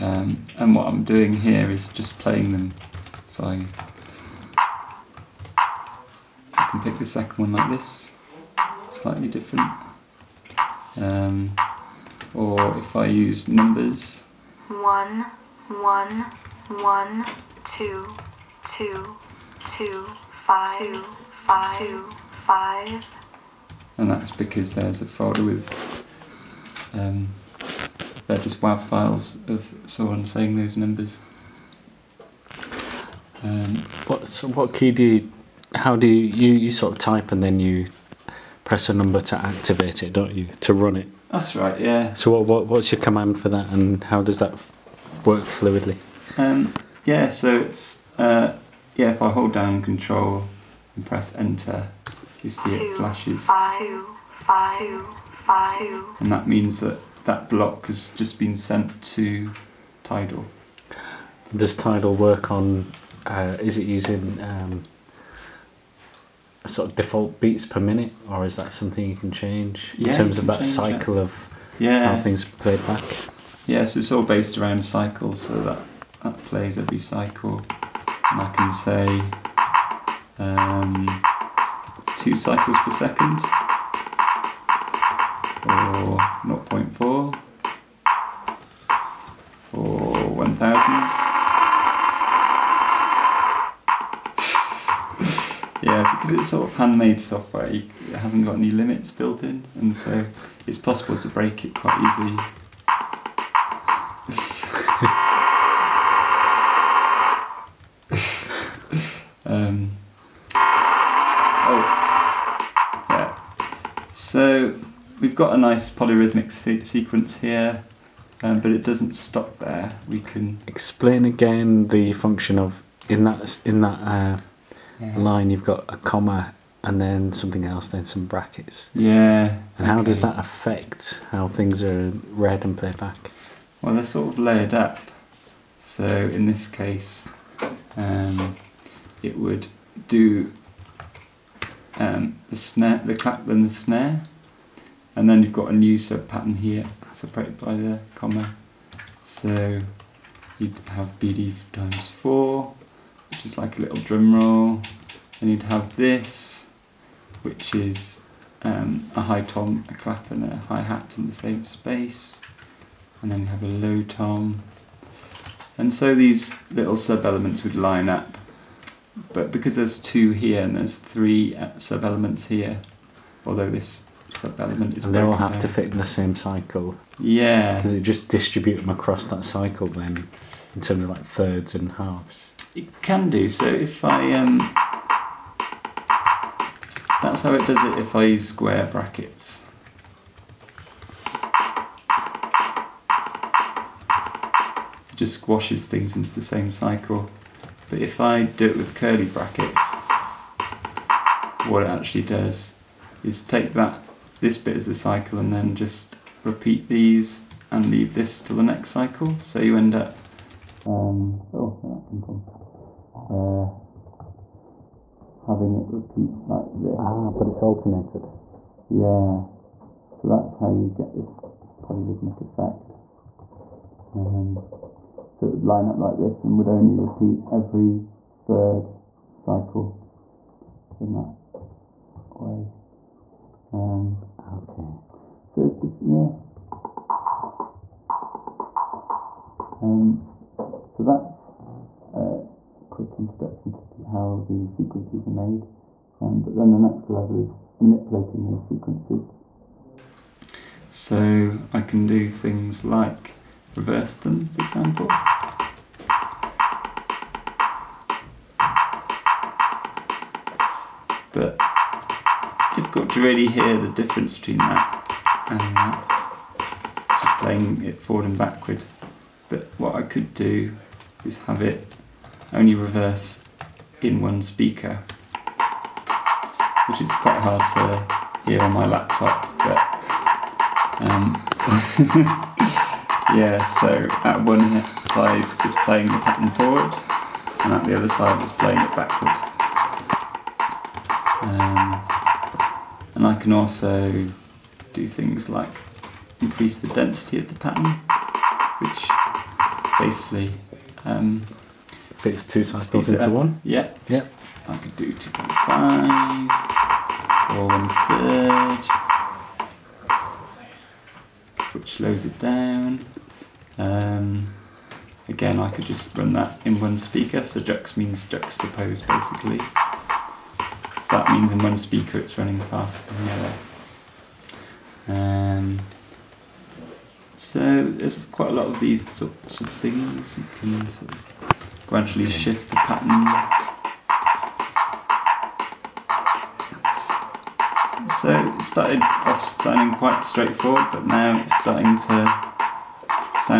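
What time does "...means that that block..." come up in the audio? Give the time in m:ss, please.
0:56.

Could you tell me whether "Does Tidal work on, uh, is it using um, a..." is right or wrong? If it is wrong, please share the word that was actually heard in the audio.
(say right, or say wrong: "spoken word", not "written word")
right.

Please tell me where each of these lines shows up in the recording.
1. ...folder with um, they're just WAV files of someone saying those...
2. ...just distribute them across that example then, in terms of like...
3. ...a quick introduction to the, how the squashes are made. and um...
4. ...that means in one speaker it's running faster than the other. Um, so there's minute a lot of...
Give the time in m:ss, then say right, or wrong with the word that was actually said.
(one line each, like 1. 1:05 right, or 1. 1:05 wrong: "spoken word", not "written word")
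1. 0:25 right
2. 2:58 wrong: "cycle", not "example"
3. 4:02 wrong: "sequences", not "squashes"
4. 5:21 wrong: "quite", not "minute".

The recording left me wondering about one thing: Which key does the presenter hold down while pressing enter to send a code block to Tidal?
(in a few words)
Control.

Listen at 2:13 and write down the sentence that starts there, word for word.
Well, they're sort of layered up.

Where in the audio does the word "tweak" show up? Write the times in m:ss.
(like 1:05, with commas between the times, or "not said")
not said.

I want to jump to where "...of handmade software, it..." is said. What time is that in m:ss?
1:36.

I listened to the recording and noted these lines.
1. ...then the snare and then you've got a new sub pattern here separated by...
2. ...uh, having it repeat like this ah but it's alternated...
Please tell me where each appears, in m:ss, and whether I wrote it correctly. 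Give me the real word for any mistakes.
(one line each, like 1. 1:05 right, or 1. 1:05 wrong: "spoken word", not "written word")
1. 2:23 right
2. 3:33 right.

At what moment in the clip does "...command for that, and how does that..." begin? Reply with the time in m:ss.
0:43.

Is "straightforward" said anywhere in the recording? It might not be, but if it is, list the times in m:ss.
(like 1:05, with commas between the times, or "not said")
5:40.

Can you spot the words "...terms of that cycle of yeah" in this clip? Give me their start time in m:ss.
1:10.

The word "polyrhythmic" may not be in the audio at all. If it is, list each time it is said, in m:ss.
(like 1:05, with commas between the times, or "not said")
1:55, 3:41.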